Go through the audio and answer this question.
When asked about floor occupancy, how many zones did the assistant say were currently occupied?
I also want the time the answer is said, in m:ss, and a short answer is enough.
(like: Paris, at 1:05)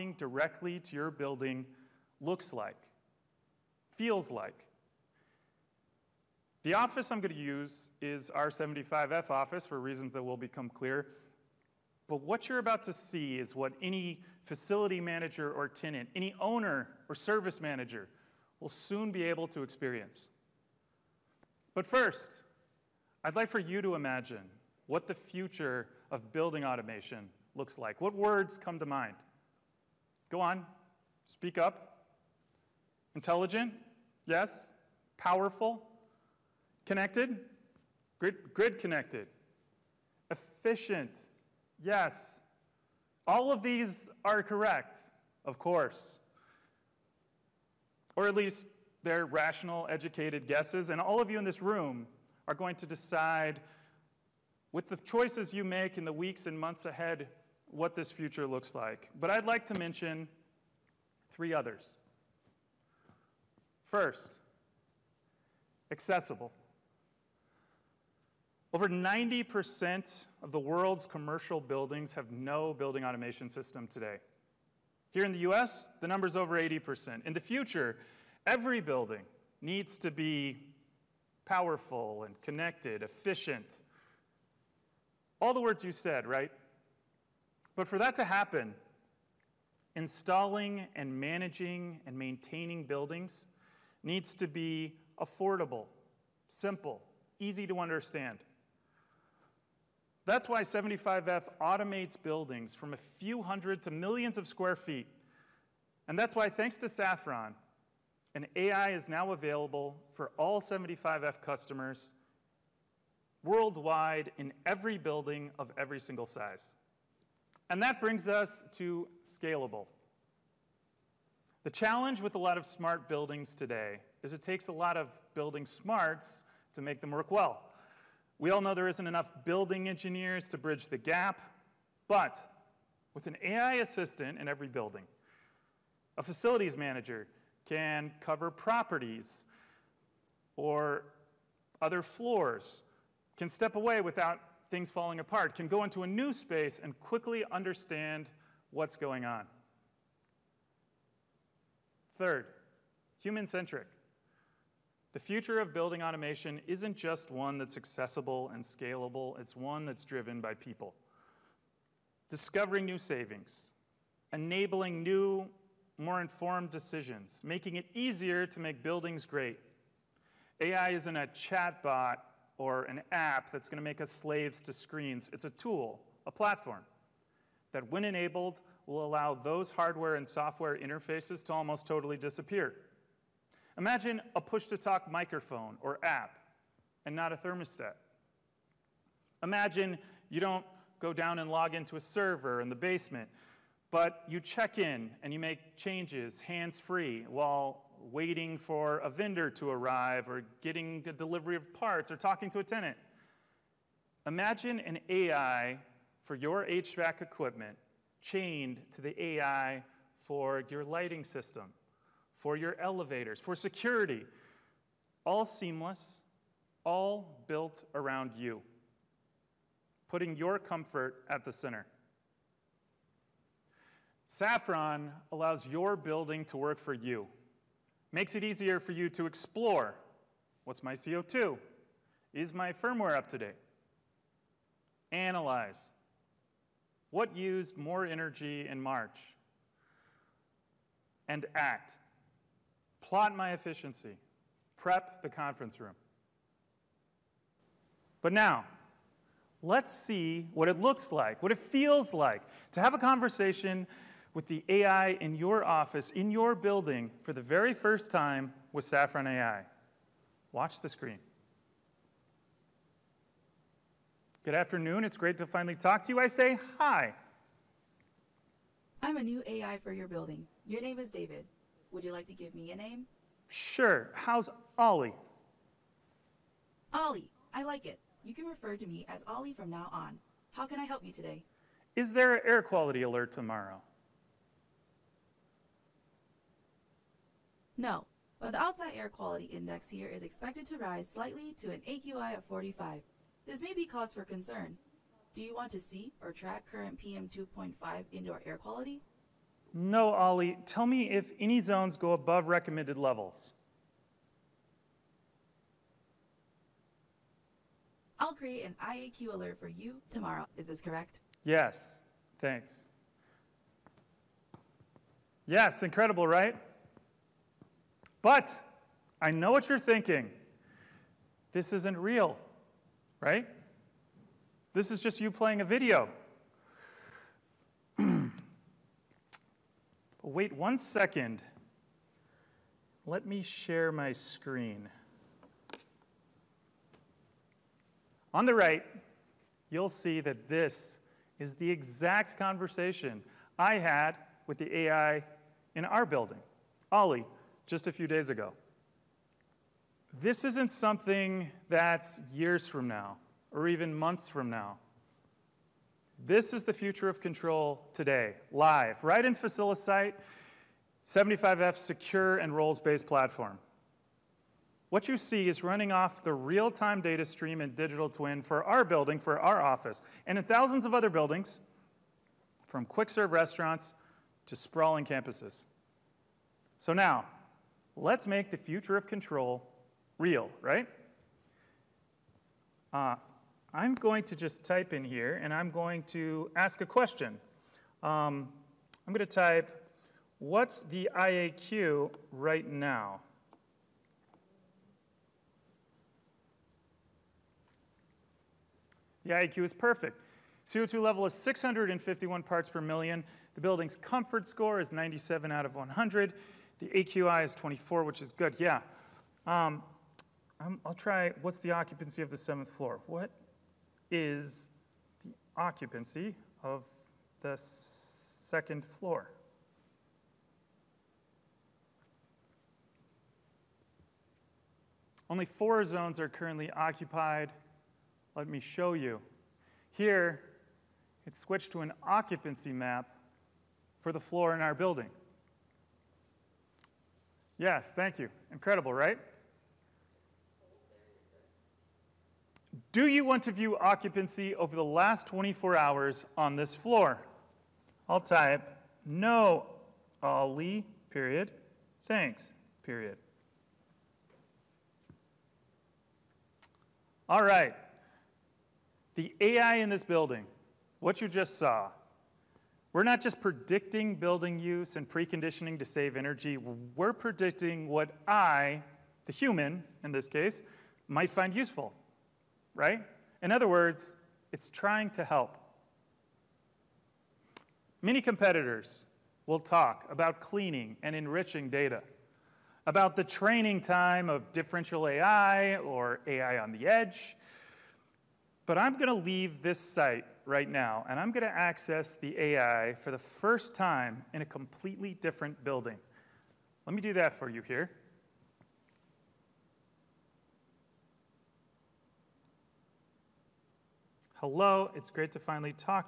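4, at 7:05.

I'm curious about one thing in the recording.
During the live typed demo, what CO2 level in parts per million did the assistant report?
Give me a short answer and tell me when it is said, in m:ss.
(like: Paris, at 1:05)
651, at 6:41.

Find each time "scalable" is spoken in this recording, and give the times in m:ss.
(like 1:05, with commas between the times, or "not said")
1:59, 2:38.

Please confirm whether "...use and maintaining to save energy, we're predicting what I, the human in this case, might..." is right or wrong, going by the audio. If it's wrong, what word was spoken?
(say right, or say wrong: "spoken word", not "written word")
wrong: "preconditioning", not "maintaining".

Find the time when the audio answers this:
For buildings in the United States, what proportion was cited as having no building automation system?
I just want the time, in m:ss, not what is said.
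1:16.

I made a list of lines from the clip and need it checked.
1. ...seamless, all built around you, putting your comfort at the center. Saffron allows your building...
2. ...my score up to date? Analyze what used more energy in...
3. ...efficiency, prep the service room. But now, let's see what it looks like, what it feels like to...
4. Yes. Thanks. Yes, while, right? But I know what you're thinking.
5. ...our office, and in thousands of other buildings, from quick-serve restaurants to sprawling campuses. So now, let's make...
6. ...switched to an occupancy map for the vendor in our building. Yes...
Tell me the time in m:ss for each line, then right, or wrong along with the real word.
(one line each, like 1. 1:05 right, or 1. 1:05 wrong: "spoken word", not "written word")
1. 3:35 right
2. 3:52 wrong: "firmware", not "score"
3. 4:03 wrong: "conference", not "service"
4. 5:11 wrong: "incredible", not "while"
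5. 6:09 right
6. 7:11 wrong: "floor", not "vendor".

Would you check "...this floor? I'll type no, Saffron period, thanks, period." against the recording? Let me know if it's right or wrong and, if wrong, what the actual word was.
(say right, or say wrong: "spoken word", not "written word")
wrong: "Ollie", not "Saffron".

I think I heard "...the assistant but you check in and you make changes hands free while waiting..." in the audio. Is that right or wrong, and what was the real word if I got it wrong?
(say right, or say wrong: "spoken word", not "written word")
wrong: "basement", not "assistant".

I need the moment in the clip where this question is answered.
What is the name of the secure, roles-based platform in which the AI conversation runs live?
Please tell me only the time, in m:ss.
5:59.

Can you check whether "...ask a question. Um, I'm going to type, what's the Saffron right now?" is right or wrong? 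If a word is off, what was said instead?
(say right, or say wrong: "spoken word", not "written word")
wrong: "IAQ", not "Saffron".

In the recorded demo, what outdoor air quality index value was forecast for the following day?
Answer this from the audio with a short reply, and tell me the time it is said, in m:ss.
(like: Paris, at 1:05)
45, at 4:51.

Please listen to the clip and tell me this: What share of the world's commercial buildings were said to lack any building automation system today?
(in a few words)
over 90%.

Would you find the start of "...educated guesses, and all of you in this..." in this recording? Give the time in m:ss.
0:49.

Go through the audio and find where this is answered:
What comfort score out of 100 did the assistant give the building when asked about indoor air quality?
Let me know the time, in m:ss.
6:44.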